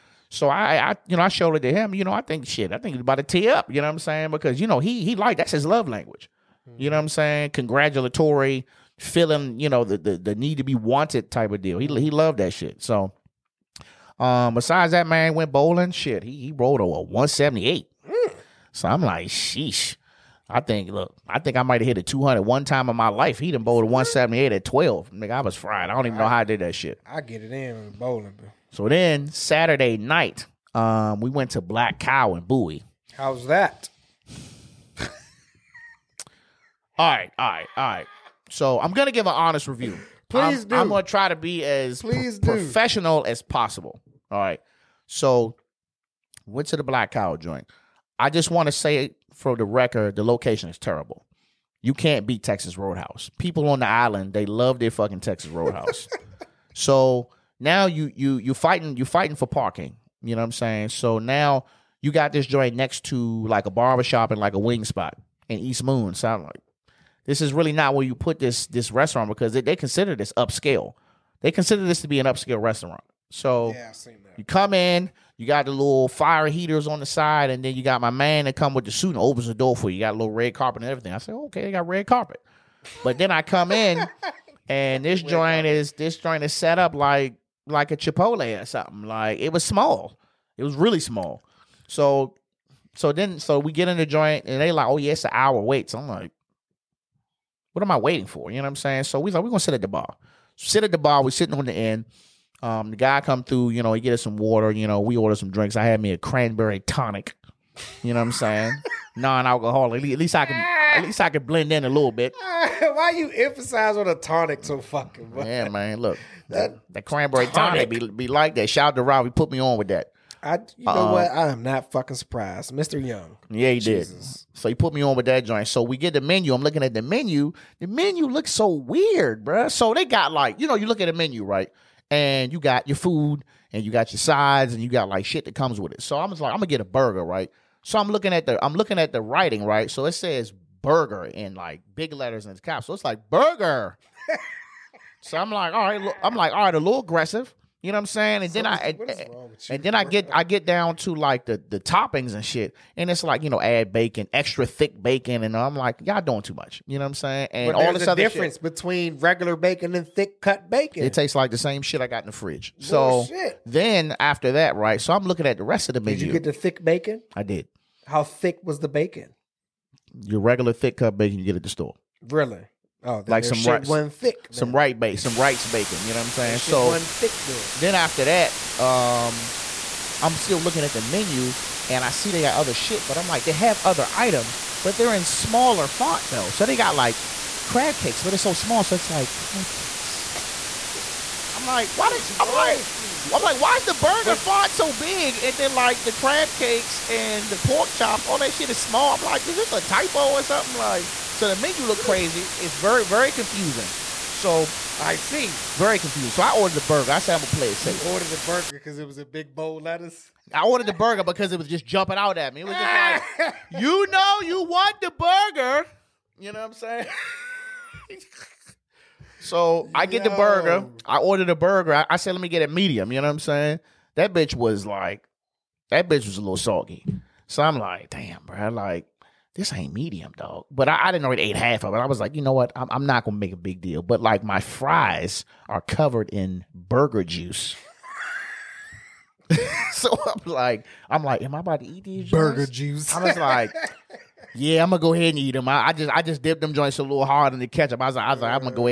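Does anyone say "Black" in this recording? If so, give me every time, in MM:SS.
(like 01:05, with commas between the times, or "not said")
00:31, 00:46.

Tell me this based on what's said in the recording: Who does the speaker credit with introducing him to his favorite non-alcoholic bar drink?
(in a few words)
Rob.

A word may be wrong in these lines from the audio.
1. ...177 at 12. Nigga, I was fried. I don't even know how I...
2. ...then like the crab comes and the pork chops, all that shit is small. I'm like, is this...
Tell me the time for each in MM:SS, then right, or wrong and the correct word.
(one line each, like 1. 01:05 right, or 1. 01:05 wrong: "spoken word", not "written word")
1. 00:23 wrong: "178", not "177"
2. 03:15 wrong: "cakes", not "comes".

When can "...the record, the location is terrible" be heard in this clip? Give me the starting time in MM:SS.
00:49.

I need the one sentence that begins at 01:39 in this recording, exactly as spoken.
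So we like, we're gonna sit at the bar.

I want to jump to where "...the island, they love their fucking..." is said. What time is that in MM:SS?
00:53.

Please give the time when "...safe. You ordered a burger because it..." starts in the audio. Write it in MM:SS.
03:27.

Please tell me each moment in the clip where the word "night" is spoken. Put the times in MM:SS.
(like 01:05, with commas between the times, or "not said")
00:29.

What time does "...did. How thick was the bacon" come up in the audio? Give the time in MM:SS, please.
02:47.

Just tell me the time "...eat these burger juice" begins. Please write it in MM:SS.
04:01.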